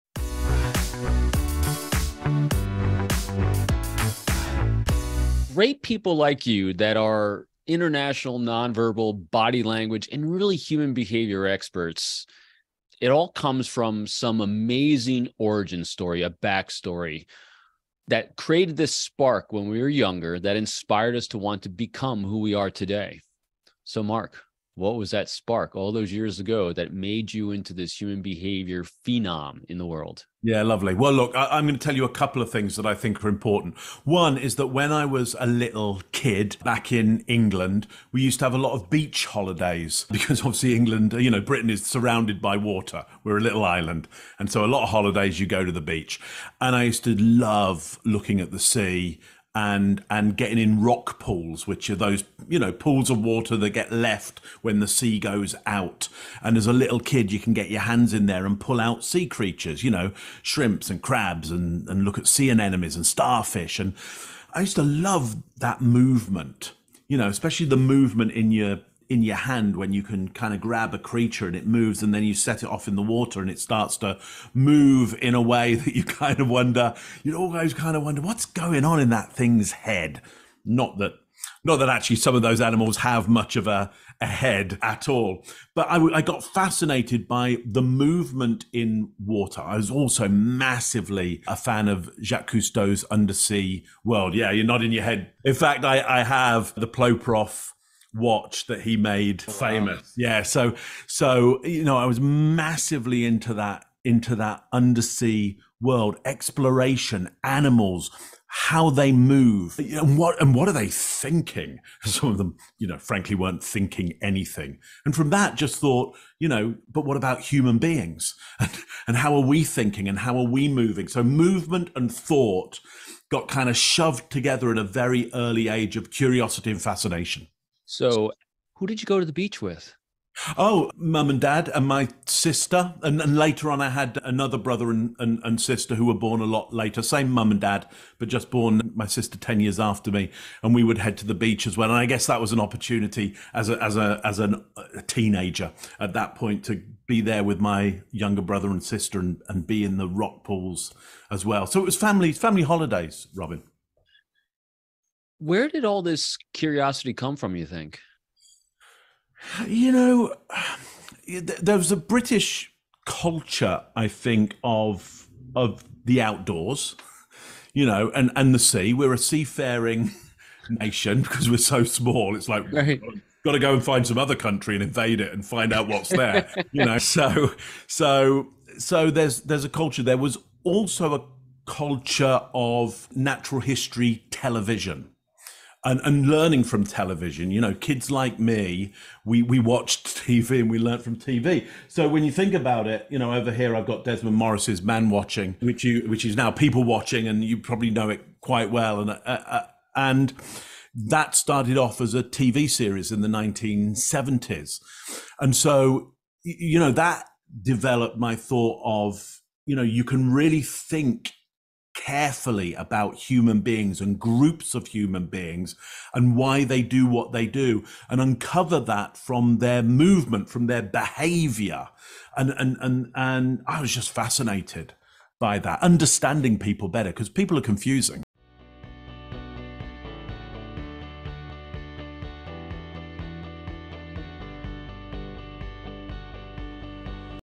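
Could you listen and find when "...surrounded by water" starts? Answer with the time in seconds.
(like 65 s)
41 s.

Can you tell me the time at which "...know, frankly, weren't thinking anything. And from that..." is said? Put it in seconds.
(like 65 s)
112 s.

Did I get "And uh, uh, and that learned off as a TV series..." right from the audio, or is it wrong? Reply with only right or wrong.
wrong.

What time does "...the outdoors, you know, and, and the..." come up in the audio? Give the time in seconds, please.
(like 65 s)
166 s.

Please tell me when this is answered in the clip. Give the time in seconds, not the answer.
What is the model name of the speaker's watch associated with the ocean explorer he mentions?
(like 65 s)
96 s.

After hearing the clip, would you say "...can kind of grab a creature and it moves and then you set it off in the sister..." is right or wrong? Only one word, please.
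wrong.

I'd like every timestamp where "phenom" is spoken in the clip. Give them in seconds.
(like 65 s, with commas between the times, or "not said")
28 s.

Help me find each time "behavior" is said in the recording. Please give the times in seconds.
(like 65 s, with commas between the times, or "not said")
10 s, 28 s, 220 s.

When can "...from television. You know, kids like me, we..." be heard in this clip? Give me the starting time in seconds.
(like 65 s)
186 s.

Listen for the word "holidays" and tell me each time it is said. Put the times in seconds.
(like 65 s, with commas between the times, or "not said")
39 s, 44 s, 152 s.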